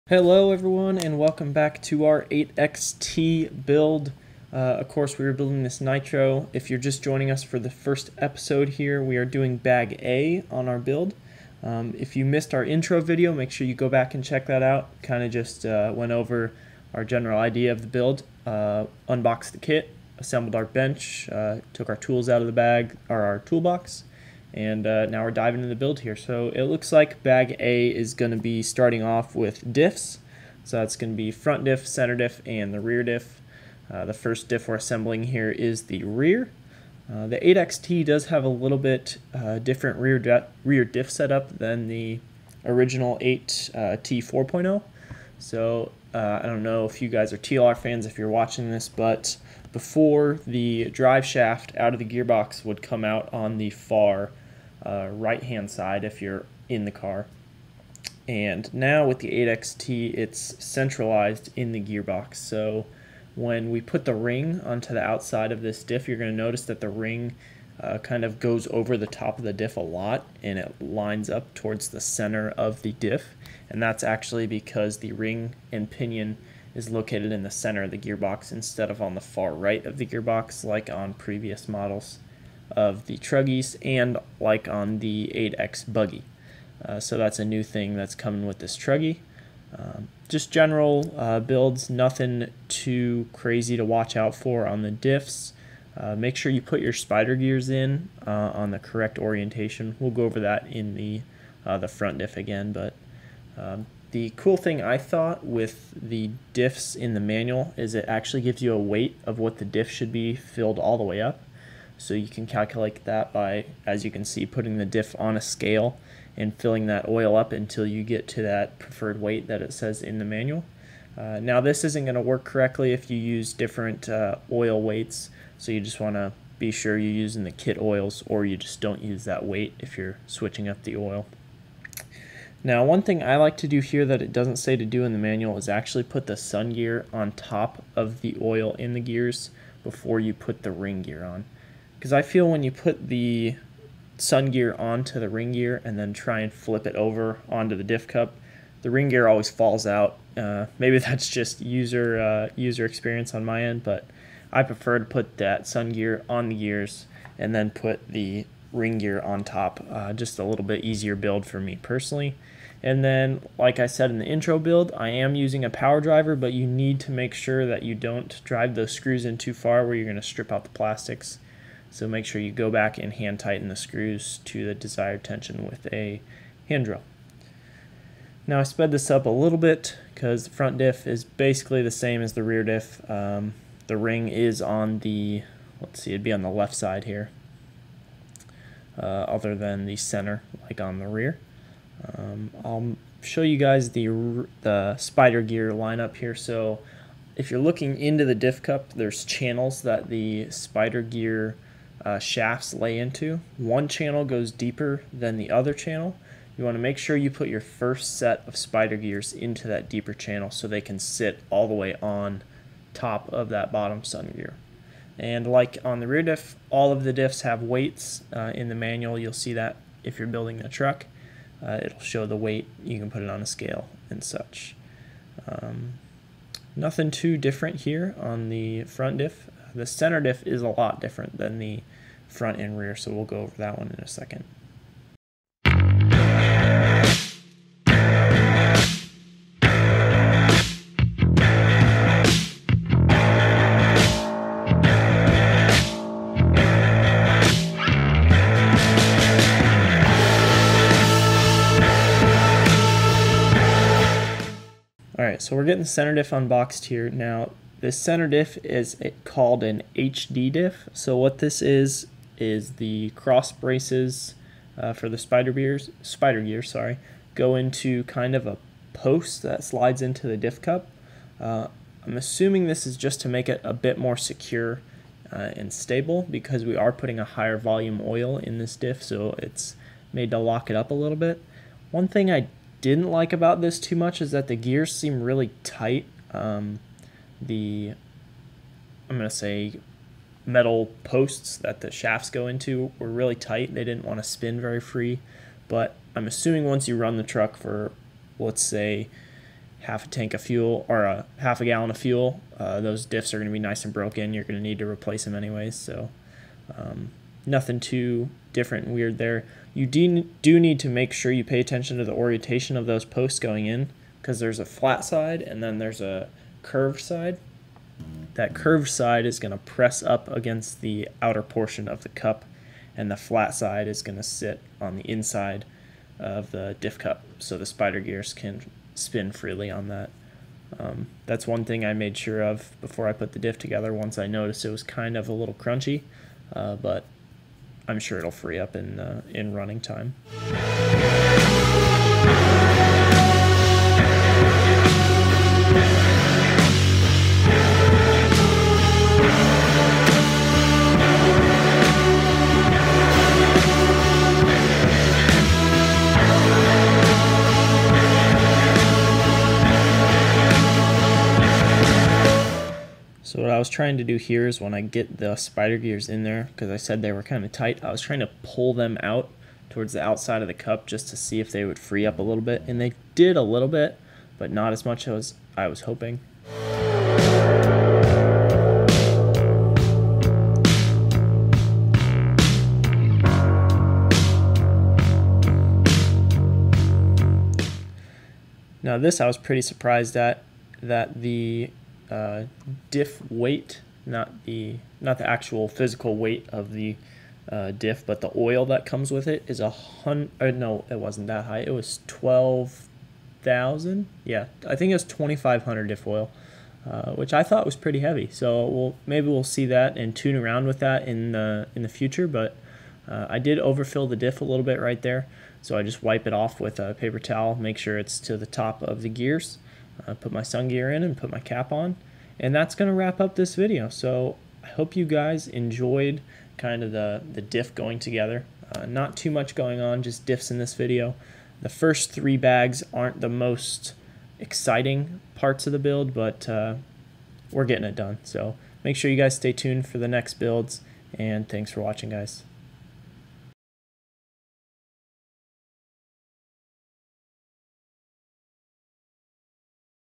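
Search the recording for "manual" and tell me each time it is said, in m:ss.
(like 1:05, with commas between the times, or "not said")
1:47, 2:00, 2:15, 3:38.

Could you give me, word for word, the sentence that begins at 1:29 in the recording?
Um, just general uh, builds, nothing too crazy to watch out for on the diffs.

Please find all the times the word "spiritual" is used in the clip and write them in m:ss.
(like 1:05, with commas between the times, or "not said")
not said.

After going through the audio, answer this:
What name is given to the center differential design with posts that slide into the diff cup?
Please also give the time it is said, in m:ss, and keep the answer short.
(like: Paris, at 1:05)
HD diff, at 4:19.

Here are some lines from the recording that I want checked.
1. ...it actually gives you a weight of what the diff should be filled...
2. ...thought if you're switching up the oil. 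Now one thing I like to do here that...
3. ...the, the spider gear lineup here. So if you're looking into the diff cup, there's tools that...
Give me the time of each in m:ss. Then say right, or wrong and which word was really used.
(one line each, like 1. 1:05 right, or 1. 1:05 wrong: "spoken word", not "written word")
1. 1:47 right
2. 2:09 wrong: "weight", not "thought"
3. 3:13 wrong: "channels", not "tools".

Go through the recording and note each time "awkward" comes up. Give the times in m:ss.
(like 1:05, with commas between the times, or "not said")
not said.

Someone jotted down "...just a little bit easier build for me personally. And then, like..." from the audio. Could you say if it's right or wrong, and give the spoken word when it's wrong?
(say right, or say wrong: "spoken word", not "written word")
right.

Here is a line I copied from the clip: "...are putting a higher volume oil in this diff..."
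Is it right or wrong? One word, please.
right.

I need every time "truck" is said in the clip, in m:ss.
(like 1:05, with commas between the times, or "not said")
3:40, 4:57.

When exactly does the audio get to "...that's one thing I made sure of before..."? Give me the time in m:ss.
5:31.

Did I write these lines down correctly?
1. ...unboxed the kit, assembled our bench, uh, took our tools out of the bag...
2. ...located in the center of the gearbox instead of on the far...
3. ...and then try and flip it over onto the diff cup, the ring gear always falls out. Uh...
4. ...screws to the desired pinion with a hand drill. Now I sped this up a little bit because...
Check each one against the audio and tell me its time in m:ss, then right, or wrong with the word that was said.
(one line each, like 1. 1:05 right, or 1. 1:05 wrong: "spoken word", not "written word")
1. 0:19 right
2. 1:16 right
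3. 2:25 right
4. 2:53 wrong: "tension", not "pinion".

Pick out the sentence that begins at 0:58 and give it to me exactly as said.
And now with the 8XT, it's centralized in the gearbox.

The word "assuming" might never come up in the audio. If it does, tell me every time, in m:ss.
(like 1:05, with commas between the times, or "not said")
4:32, 4:56.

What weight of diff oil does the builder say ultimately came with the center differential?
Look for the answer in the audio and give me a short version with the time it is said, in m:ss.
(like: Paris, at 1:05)
2500, at 6:45.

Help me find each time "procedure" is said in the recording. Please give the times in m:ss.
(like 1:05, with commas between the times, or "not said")
not said.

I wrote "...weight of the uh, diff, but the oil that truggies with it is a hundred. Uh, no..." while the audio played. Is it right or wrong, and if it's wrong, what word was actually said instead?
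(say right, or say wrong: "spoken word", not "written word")
wrong: "comes", not "truggies".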